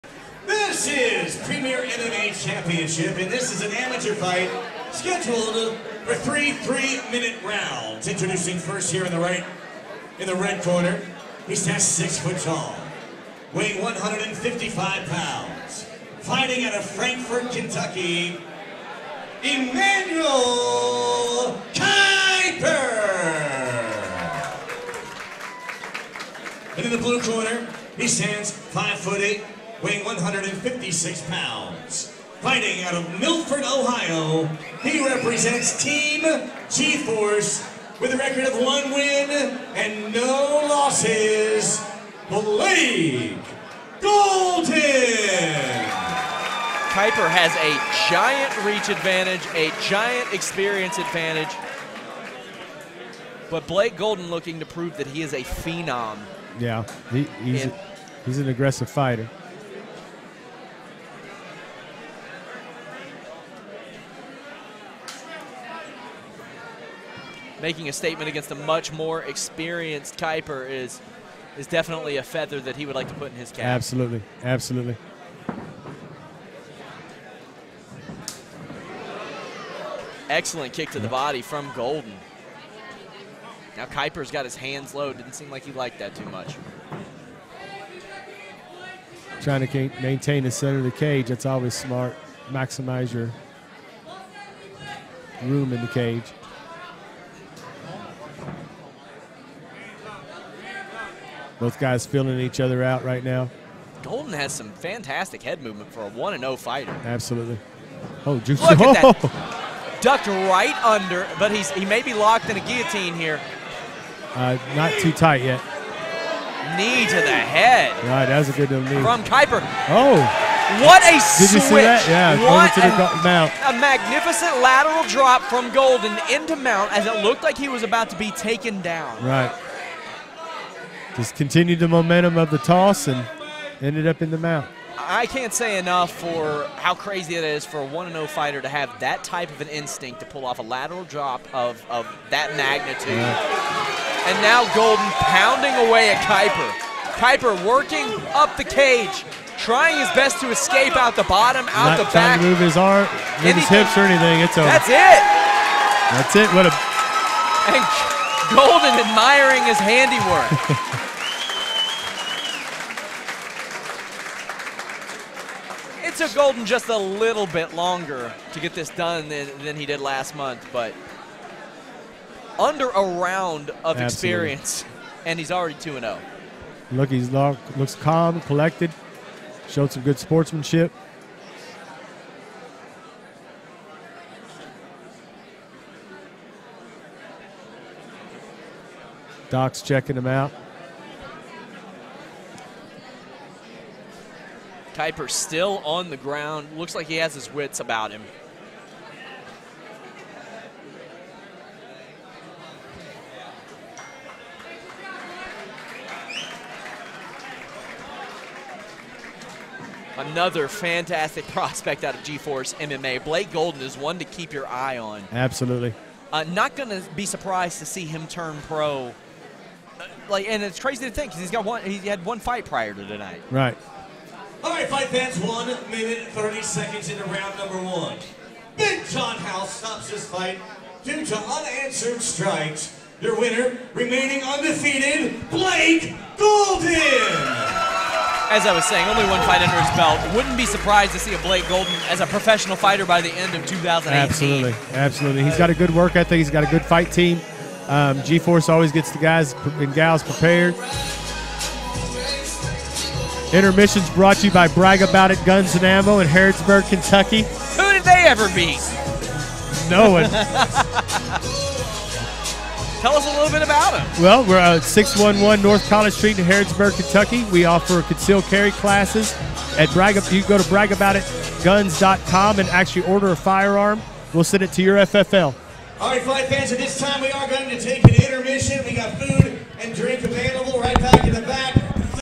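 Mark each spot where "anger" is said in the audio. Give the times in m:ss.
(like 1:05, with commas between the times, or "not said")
not said.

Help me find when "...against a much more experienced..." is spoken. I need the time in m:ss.
1:08.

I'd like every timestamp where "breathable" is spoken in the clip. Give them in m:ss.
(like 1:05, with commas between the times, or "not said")
not said.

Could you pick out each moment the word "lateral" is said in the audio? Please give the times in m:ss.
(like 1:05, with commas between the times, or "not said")
2:04, 2:20.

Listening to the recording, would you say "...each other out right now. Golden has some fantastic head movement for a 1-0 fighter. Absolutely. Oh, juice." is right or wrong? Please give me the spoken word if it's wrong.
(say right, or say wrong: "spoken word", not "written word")
right.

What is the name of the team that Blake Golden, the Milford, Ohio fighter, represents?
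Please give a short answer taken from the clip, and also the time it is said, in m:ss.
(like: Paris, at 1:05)
Team G-Force, at 0:35.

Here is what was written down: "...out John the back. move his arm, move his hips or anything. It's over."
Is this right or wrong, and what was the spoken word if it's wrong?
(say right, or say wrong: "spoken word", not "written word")
wrong: "Not", not "John".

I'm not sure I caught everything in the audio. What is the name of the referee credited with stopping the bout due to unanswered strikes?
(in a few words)
Big John House.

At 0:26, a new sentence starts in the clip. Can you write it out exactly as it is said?
And in the blue corner, he stands five foot eight, weighing 156 pounds.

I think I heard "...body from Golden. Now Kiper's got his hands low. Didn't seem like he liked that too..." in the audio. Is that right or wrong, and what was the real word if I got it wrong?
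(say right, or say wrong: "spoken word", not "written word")
right.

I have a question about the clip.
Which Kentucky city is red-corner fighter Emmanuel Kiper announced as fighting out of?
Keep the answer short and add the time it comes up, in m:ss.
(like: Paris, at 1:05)
Frankfort, Kentucky, at 0:16.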